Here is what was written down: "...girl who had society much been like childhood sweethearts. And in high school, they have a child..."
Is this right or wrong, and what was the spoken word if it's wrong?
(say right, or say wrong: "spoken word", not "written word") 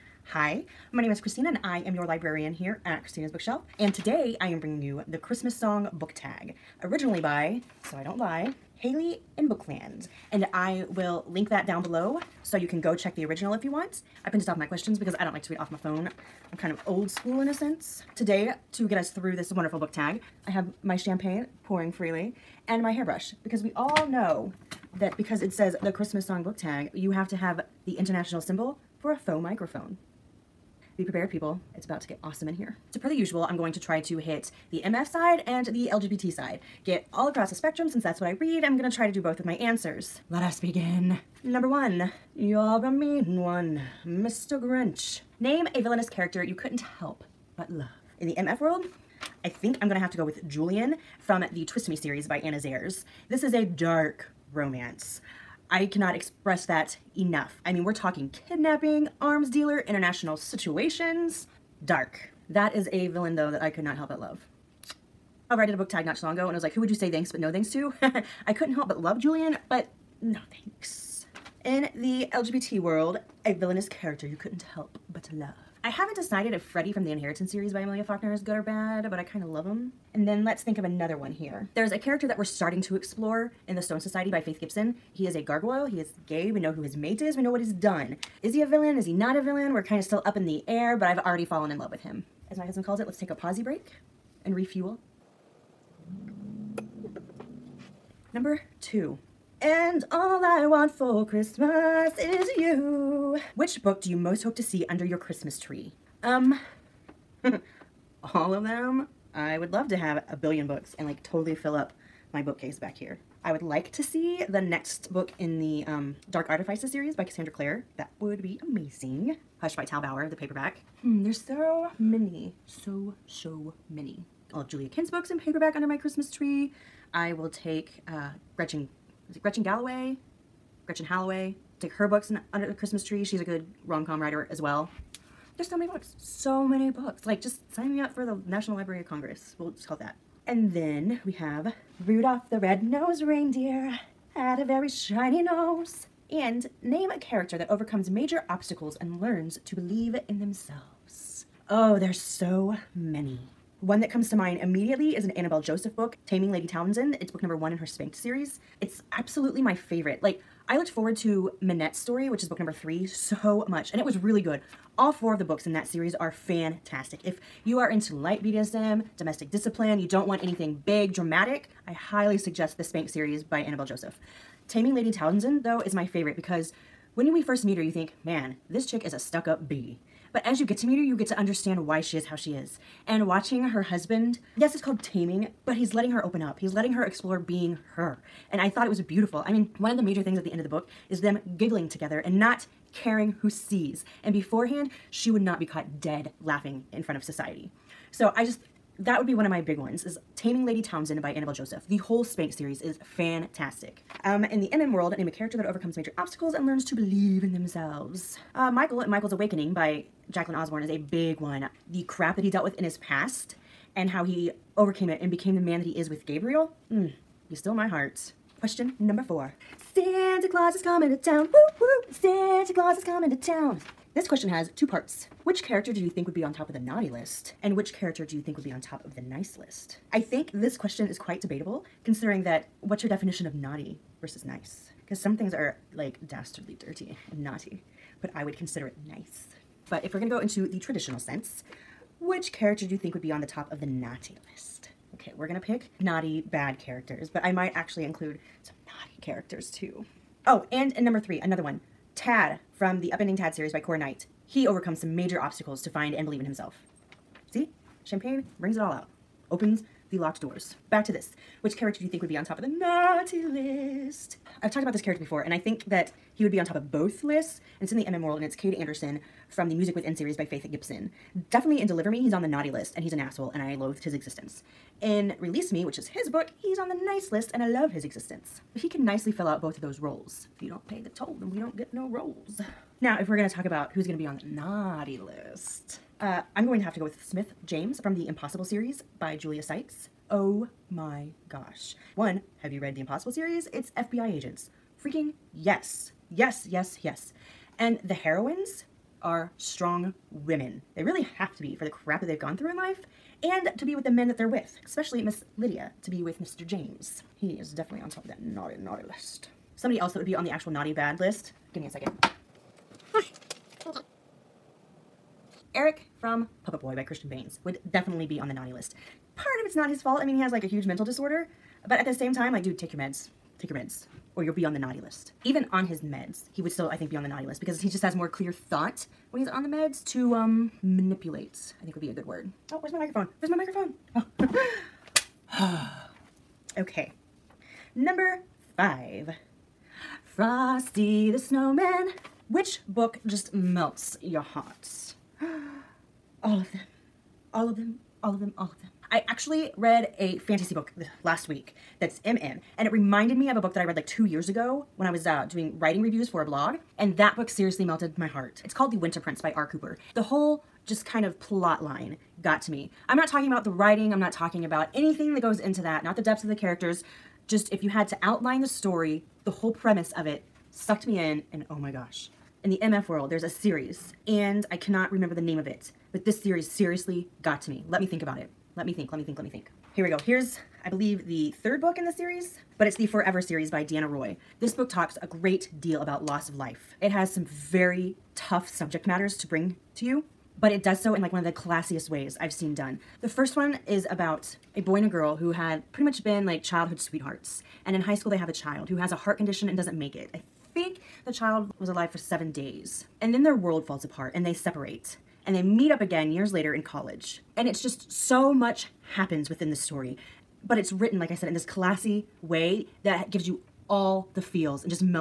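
wrong: "pretty", not "society".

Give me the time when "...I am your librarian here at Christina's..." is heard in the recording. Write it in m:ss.
0:01.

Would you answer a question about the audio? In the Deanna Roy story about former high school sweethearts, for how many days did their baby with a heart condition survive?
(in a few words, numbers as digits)
7.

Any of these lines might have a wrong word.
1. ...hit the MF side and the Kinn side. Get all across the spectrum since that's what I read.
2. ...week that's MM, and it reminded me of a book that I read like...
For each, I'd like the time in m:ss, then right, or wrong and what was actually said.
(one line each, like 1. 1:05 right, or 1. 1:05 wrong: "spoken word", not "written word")
1. 0:34 wrong: "LGBT", not "Kinn"
2. 5:51 right.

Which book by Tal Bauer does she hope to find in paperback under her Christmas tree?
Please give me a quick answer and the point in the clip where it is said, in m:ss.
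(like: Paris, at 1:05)
Hush, at 1:59.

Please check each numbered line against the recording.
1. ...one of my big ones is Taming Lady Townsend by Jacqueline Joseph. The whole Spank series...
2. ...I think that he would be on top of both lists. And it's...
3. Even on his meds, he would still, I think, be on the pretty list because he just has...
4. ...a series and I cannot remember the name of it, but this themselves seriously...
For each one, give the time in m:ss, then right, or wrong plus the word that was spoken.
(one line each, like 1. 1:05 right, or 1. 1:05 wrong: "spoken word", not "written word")
1. 3:19 wrong: "Annabel", not "Jacqueline"
2. 4:25 right
3. 5:25 wrong: "naughty", not "pretty"
4. 6:13 wrong: "series", not "themselves".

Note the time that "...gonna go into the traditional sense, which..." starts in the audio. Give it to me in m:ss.
4:00.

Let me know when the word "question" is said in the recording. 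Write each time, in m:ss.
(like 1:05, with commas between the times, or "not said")
0:14, 3:38, 3:44, 3:50.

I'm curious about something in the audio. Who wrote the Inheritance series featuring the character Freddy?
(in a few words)
Amelia Faulkner.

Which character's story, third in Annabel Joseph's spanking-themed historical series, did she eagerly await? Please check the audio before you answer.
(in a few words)
Minette.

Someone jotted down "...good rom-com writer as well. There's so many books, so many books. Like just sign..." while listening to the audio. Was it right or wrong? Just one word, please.
right.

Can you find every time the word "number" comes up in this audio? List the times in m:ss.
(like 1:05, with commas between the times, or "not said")
0:41, 1:38, 2:37, 2:42, 3:38, 4:11, 5:37.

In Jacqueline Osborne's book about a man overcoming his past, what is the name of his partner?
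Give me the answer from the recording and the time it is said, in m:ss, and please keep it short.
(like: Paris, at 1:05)
Gabriel, at 3:36.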